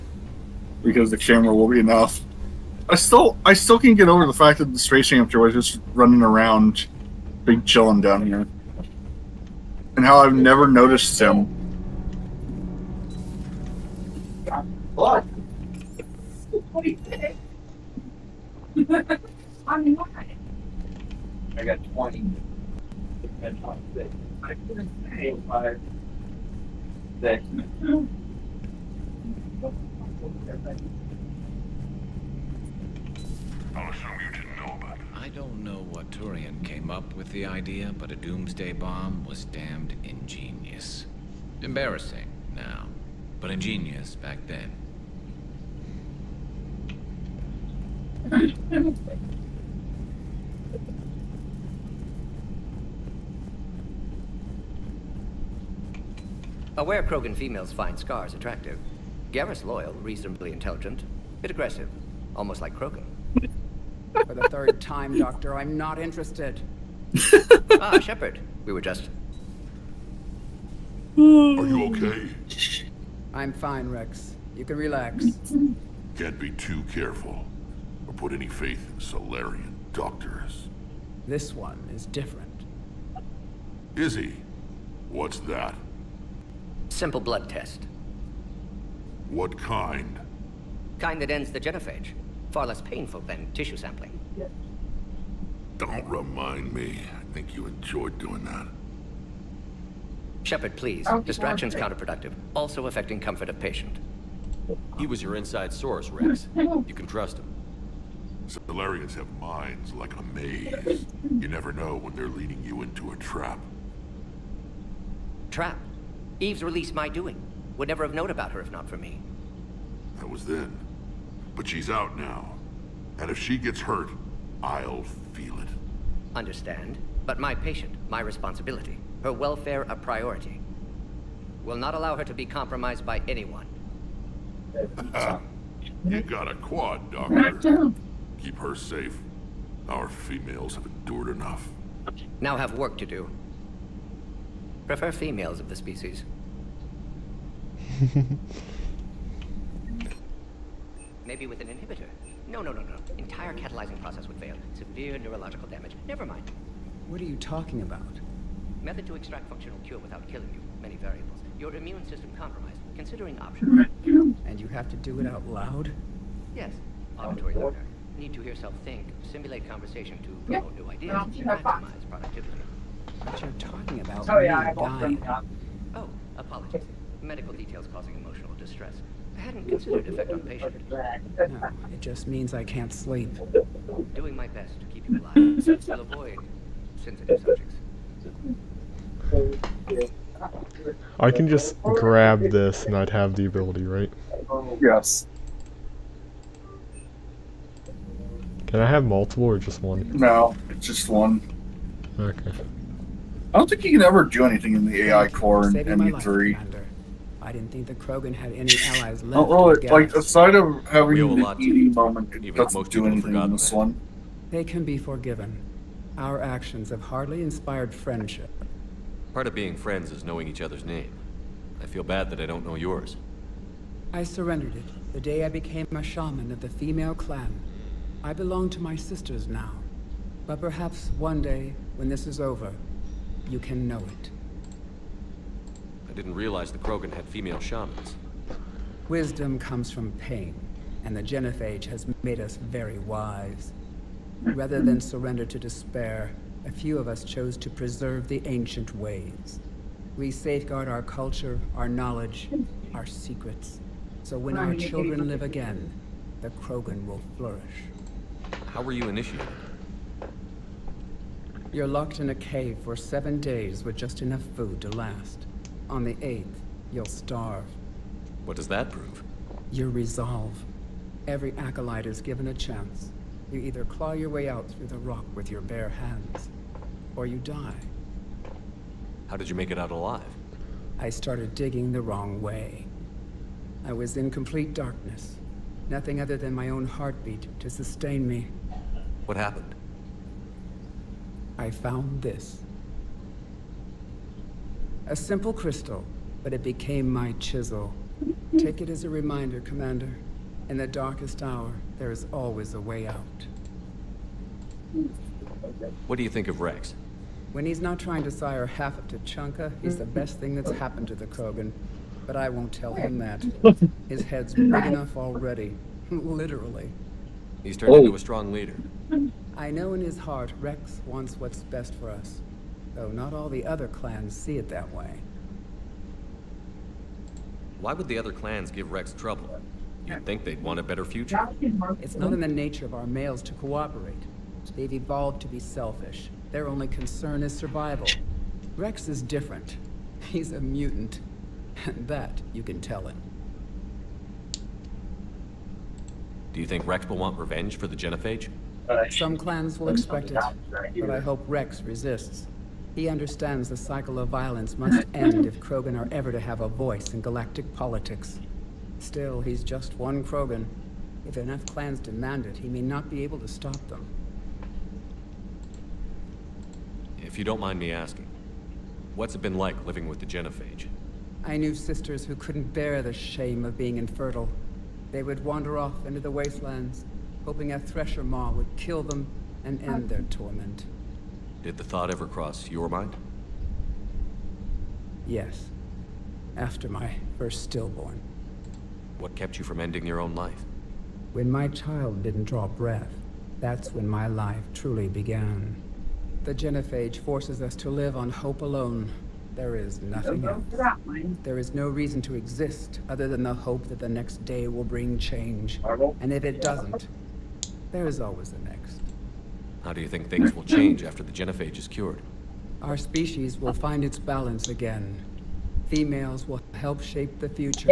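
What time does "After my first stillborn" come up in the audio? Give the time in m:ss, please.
6:26.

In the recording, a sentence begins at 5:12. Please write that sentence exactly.
But I won't tell him that.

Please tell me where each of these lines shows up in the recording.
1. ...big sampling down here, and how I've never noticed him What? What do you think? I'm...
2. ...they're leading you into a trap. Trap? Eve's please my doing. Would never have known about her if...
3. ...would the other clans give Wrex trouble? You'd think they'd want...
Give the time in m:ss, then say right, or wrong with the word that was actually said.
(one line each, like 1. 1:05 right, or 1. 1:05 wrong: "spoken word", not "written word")
1. 0:07 wrong: "chilling", not "sampling"
2. 1:52 wrong: "release", not "please"
3. 5:27 right.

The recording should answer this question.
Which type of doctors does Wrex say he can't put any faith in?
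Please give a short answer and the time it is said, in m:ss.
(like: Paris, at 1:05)
Salarian doctors, at 1:19.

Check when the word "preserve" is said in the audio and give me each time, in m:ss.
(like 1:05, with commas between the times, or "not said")
4:07.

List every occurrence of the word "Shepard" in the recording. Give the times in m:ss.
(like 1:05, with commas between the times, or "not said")
1:07, 1:40.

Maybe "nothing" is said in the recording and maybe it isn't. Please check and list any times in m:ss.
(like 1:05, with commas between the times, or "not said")
4:45, 6:40.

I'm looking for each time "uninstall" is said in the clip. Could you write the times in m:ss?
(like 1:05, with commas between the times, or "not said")
not said.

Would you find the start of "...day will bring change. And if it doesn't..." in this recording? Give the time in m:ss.
6:44.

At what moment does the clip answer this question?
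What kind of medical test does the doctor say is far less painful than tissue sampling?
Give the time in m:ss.
1:26.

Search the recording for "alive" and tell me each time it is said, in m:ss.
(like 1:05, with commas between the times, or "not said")
3:05, 4:39.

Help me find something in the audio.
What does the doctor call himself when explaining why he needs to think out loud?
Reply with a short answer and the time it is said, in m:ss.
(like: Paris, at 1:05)
Auditory learner, at 2:47.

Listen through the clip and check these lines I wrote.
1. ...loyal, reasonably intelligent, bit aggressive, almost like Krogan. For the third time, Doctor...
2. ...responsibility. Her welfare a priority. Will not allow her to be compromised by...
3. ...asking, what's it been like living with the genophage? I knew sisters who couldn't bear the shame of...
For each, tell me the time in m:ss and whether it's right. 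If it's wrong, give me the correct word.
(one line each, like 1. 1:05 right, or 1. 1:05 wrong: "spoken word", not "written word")
1. 0:59 right
2. 2:08 right
3. 6:07 right.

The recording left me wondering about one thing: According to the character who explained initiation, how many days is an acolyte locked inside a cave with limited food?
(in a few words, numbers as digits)
7.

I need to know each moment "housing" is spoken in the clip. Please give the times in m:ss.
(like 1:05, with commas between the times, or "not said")
not said.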